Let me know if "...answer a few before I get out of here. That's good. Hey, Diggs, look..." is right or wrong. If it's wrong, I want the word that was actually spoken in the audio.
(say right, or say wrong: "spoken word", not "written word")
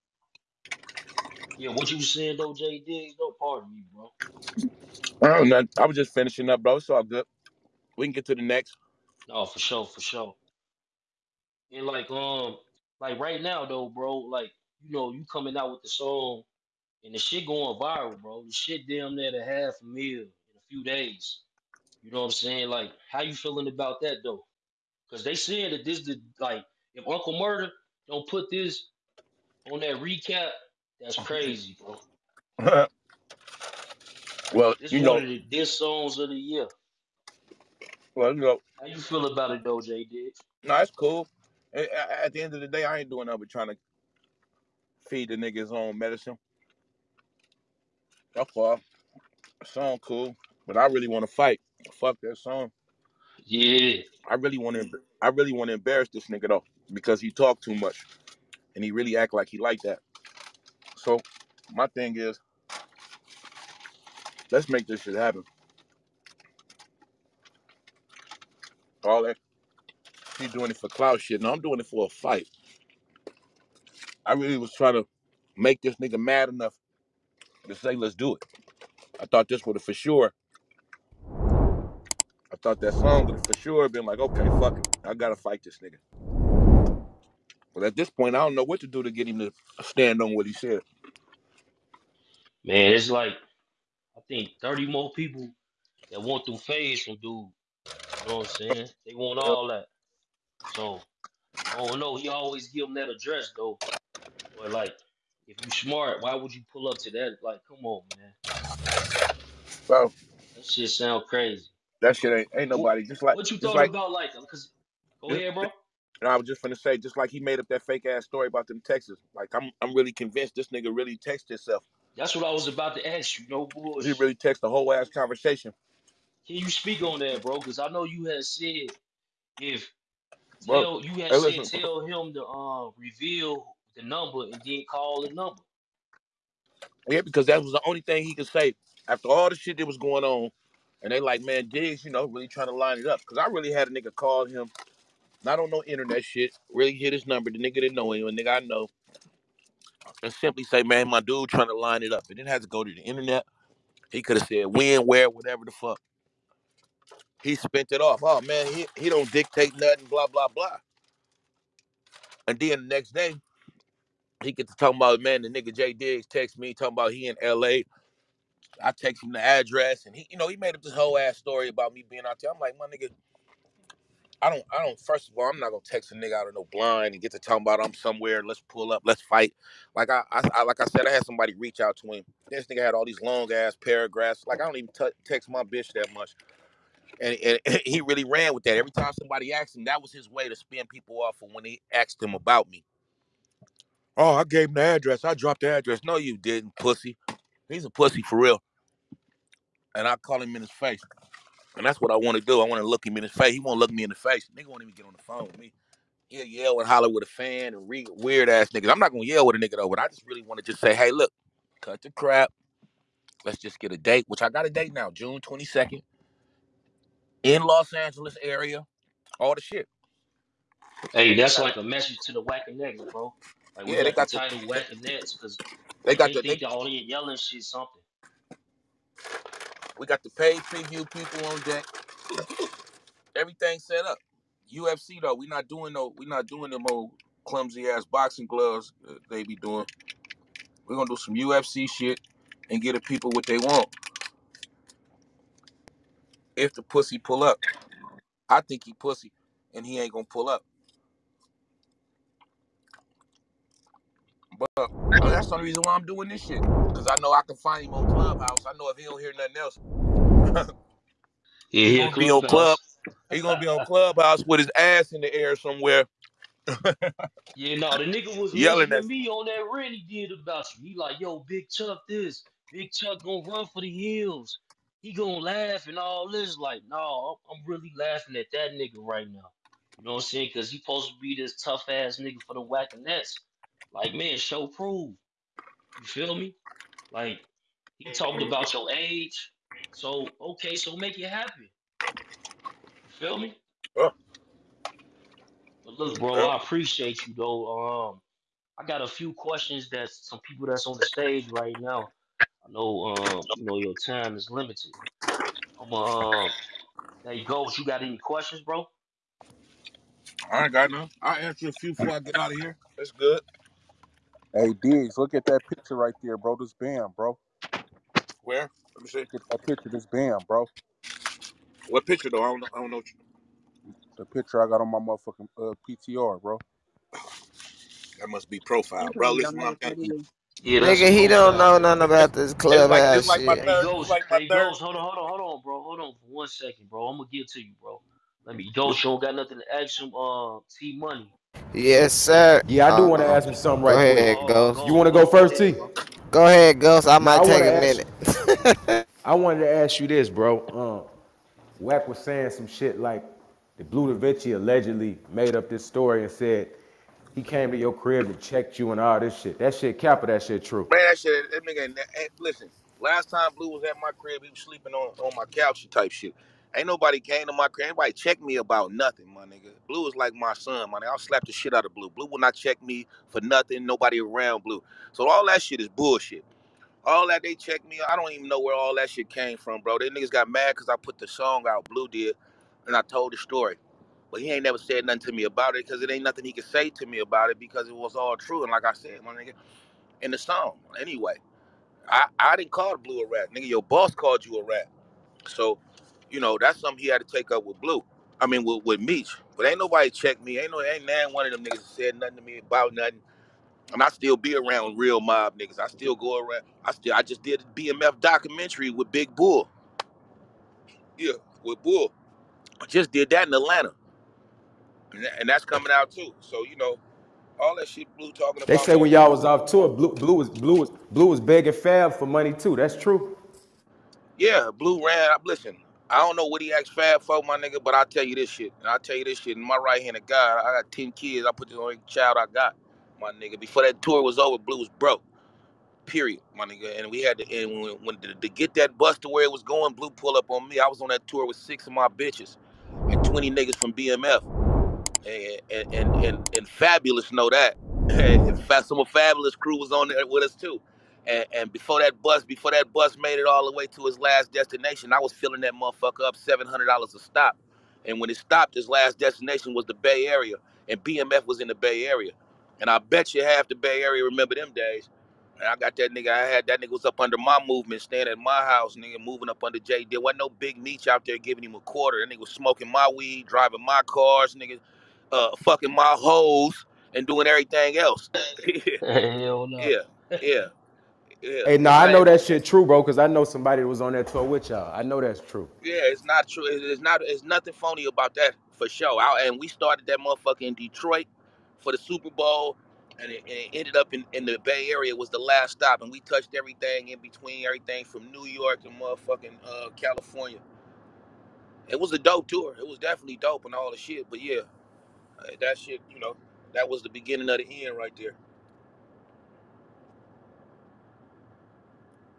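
right.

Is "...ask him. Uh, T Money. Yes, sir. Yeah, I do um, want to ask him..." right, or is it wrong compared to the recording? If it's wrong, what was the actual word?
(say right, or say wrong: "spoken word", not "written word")
right.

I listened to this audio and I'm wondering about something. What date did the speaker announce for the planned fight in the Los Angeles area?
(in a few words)
June 22nd.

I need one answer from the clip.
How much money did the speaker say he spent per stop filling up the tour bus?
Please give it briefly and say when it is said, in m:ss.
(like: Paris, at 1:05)
$700, at 7:36.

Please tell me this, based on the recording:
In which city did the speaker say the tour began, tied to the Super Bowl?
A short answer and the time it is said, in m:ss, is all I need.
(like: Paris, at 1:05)
Detroit, at 8:10.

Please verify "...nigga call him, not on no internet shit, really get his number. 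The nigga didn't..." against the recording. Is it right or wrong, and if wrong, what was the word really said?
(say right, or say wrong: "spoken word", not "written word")
right.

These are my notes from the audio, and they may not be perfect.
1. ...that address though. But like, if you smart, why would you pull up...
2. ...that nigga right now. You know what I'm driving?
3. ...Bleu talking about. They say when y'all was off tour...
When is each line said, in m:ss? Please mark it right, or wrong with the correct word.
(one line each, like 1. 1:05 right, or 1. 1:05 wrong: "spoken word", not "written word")
1. 1:42 right
2. 4:38 wrong: "saying", not "driving"
3. 6:58 right.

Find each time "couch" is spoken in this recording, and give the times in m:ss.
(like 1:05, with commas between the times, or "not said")
6:05.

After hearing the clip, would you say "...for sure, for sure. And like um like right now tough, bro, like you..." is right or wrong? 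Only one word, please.
wrong.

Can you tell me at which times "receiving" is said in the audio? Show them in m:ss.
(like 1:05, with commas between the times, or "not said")
not said.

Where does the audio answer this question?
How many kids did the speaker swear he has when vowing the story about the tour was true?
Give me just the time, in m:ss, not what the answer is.
7:10.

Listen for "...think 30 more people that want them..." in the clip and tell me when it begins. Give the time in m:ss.
1:34.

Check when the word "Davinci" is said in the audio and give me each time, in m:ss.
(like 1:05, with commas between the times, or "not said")
5:54.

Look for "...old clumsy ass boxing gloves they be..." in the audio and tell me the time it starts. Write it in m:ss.
3:56.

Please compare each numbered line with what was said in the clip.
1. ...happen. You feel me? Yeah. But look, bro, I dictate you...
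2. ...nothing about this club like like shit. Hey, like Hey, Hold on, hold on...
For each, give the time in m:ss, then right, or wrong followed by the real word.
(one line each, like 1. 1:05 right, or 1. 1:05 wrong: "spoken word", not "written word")
1. 4:51 wrong: "appreciate", not "dictate"
2. 5:31 right.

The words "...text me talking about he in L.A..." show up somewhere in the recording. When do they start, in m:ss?
2:46.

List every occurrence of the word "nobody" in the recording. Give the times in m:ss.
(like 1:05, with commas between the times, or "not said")
1:52, 6:06, 6:13, 6:39.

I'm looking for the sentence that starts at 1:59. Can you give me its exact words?
Like I'm, I'm really convinced this nigga really texted himself.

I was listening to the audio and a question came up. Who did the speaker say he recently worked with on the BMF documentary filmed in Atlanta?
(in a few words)
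Big Bull.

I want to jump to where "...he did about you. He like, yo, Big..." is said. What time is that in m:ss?
4:29.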